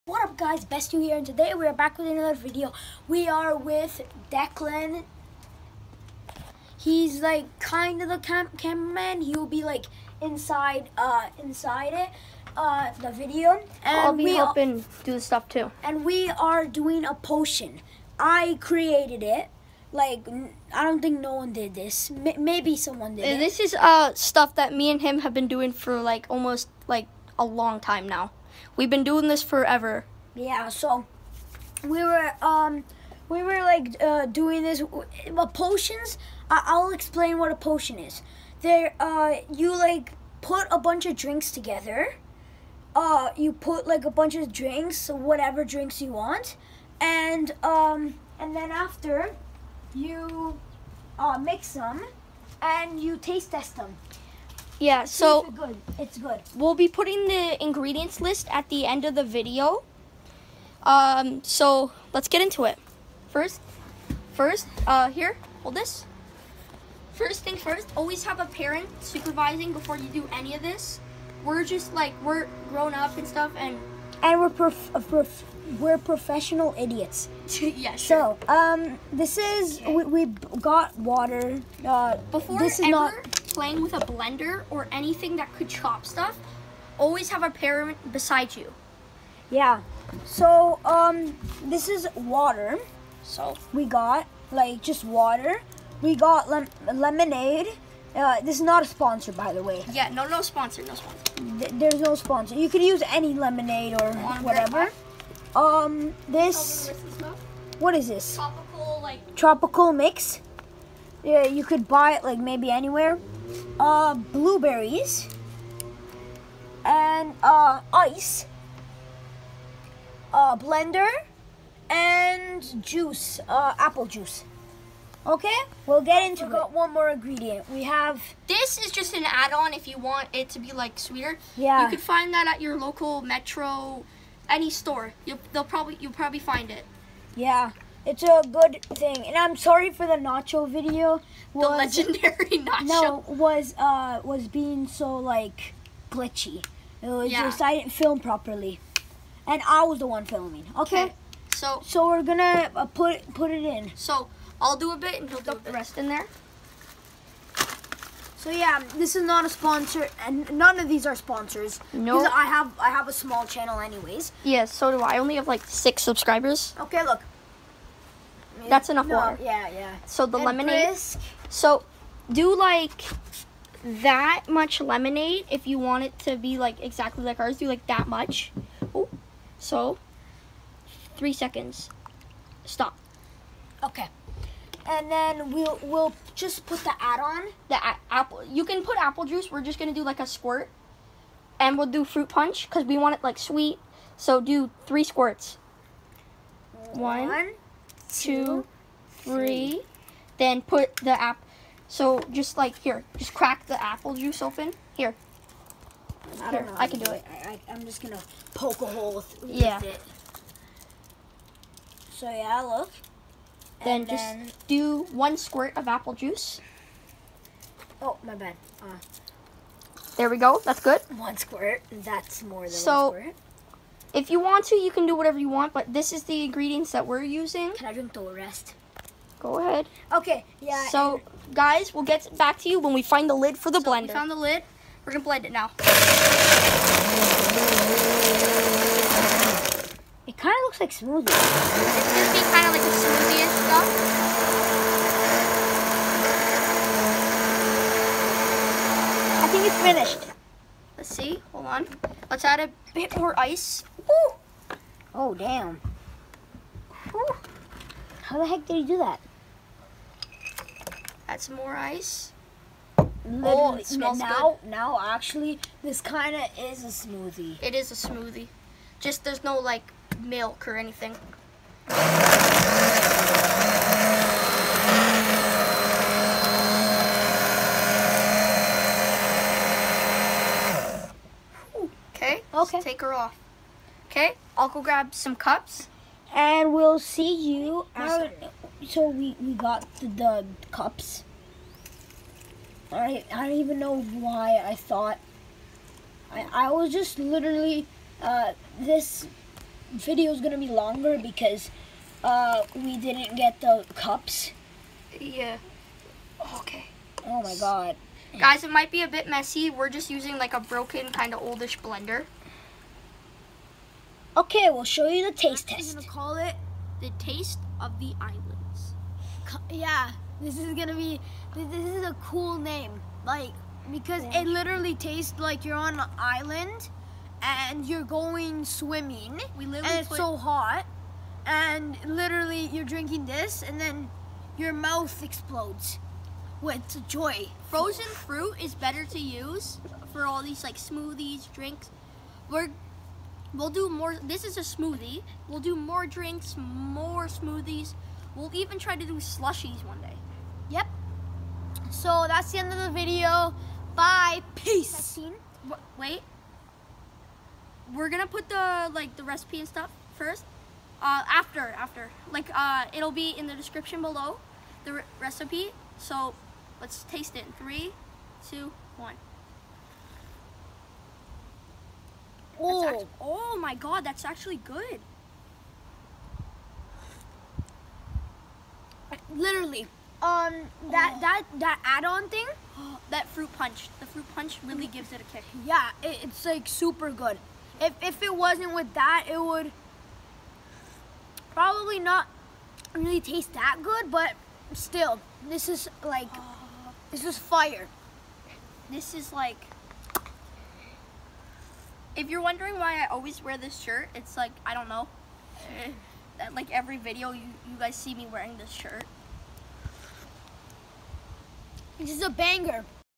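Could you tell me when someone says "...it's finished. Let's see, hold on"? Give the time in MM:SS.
04:09.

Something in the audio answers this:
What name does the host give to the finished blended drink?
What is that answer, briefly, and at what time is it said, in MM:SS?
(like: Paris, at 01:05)
The taste of the islands, at 05:17.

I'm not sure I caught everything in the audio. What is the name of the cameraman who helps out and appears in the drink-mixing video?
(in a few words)
Declan.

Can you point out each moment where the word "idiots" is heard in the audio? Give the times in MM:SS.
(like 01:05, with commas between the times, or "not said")
01:16.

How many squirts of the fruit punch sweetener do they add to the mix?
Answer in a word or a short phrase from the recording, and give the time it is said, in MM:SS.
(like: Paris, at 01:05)
3, at 03:14.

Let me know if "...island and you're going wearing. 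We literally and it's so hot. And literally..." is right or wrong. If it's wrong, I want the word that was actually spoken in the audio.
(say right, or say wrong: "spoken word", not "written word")
wrong: "swimming", not "wearing".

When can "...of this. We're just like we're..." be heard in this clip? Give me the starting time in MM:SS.
01:10.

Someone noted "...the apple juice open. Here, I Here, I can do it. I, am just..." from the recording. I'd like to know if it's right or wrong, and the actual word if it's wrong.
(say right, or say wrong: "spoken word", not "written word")
right.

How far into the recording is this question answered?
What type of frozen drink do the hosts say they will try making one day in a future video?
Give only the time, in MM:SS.
05:49.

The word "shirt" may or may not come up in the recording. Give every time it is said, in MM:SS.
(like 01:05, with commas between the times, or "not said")
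06:43, 06:48.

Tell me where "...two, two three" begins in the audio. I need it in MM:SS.
03:18.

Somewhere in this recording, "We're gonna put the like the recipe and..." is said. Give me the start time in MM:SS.
05:57.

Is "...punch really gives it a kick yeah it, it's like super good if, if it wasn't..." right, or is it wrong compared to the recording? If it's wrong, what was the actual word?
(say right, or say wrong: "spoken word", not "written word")
right.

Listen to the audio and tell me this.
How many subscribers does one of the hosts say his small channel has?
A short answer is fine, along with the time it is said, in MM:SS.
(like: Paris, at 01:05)
6, at 02:45.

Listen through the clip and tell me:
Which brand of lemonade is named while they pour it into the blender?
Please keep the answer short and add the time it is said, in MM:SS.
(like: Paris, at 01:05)
Brisk, at 02:50.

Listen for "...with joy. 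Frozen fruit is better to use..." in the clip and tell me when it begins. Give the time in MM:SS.
05:36.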